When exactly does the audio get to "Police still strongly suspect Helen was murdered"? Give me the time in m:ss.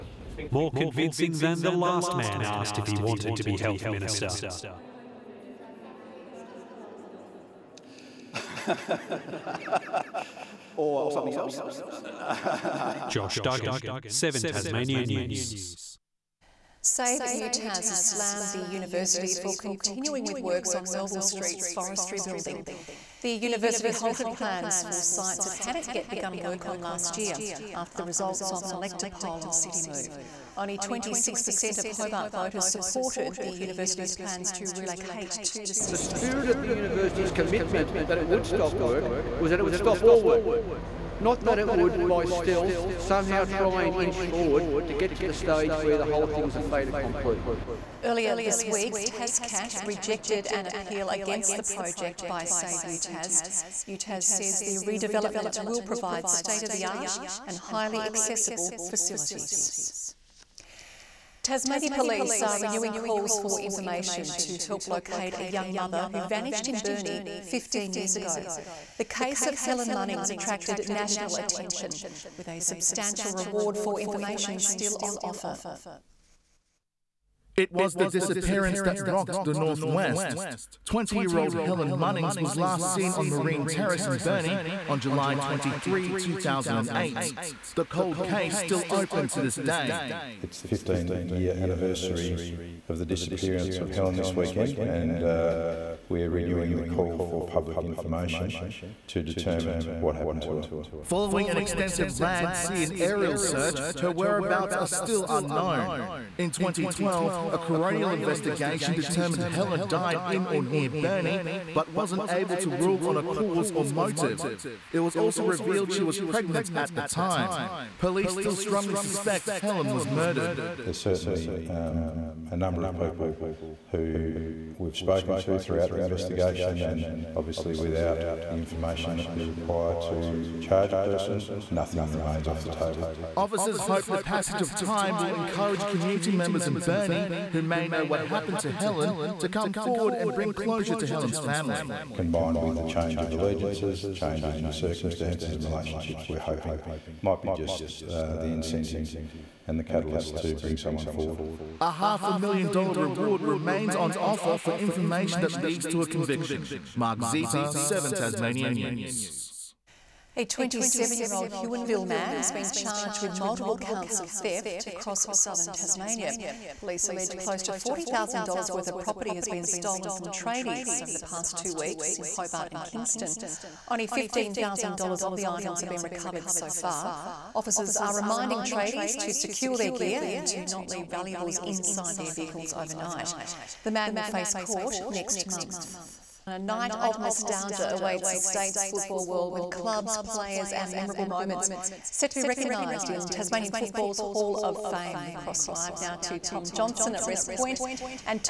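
1:57.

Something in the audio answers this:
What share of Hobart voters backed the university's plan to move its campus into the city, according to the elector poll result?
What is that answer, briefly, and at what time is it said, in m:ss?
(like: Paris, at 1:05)
26%, at 0:30.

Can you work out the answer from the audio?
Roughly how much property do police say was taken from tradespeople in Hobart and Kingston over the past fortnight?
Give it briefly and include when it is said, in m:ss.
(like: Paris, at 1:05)
$40,000, at 2:47.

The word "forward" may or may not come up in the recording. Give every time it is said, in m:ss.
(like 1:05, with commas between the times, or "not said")
0:44, 2:19, 2:31.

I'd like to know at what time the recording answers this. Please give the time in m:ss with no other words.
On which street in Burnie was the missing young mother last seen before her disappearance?
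1:23.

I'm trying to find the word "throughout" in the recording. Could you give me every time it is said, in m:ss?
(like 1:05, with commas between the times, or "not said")
2:05.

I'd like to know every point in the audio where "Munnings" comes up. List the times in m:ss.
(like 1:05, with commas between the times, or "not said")
1:09, 1:21.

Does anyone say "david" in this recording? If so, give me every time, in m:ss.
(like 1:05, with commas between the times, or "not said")
not said.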